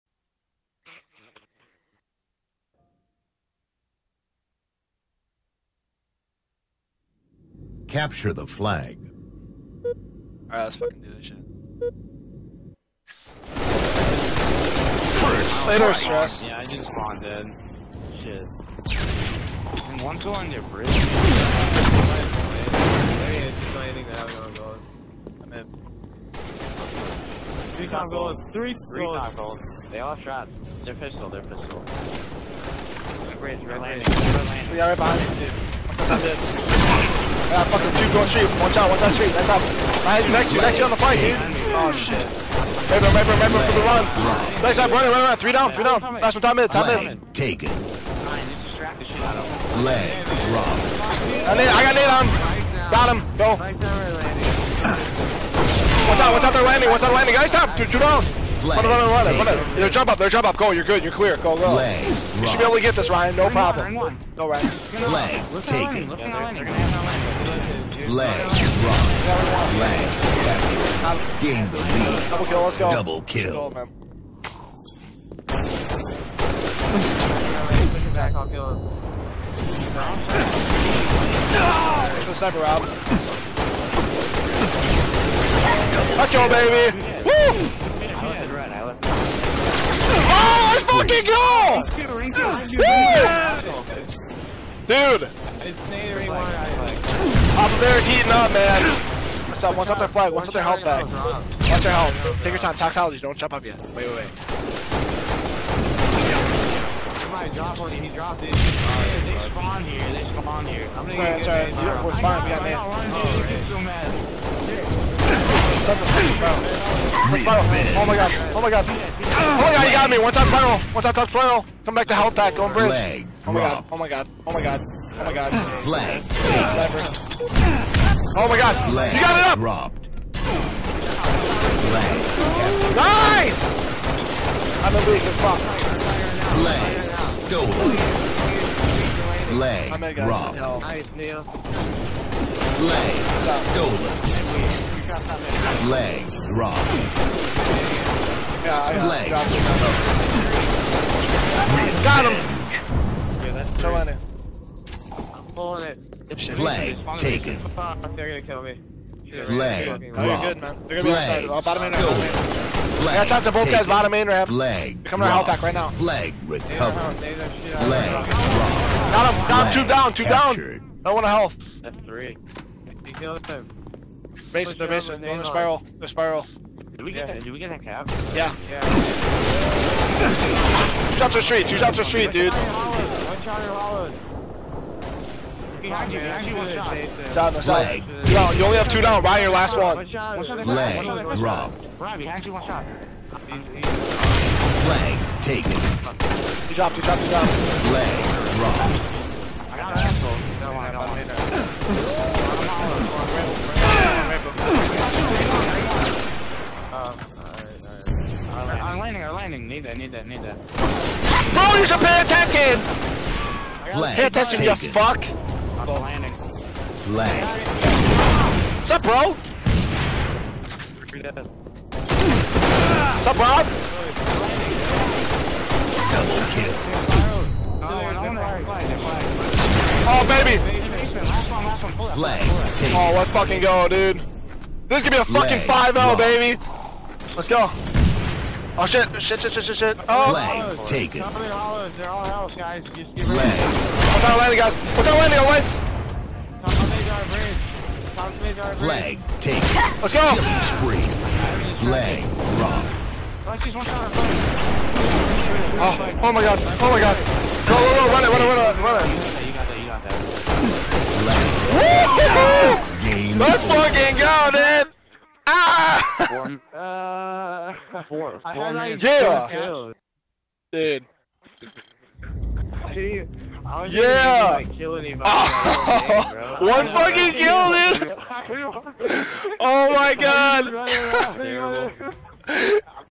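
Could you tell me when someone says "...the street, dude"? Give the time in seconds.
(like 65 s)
181 s.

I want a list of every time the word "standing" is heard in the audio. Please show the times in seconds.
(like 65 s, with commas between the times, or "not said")
not said.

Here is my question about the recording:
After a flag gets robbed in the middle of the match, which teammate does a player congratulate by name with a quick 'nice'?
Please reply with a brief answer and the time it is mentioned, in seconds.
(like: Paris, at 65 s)
Neil, at 141 s.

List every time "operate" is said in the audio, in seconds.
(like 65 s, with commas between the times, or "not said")
not said.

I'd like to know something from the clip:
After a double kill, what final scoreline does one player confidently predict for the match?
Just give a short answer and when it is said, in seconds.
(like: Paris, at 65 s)
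5-0, at 235 s.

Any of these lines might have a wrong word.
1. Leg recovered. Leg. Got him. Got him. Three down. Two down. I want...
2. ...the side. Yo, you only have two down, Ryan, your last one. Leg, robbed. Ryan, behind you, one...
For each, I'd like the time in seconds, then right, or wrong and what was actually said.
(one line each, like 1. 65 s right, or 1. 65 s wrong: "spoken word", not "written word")
1. 166 s wrong: "Two", not "Three"
2. 187 s right.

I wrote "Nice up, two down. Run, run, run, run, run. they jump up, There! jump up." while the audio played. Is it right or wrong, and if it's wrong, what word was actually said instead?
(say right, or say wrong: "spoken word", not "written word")
right.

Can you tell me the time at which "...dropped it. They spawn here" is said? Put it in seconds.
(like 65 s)
108 s.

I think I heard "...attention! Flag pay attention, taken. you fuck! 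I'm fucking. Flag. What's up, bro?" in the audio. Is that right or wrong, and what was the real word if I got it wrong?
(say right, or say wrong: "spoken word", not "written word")
wrong: "landing", not "fucking".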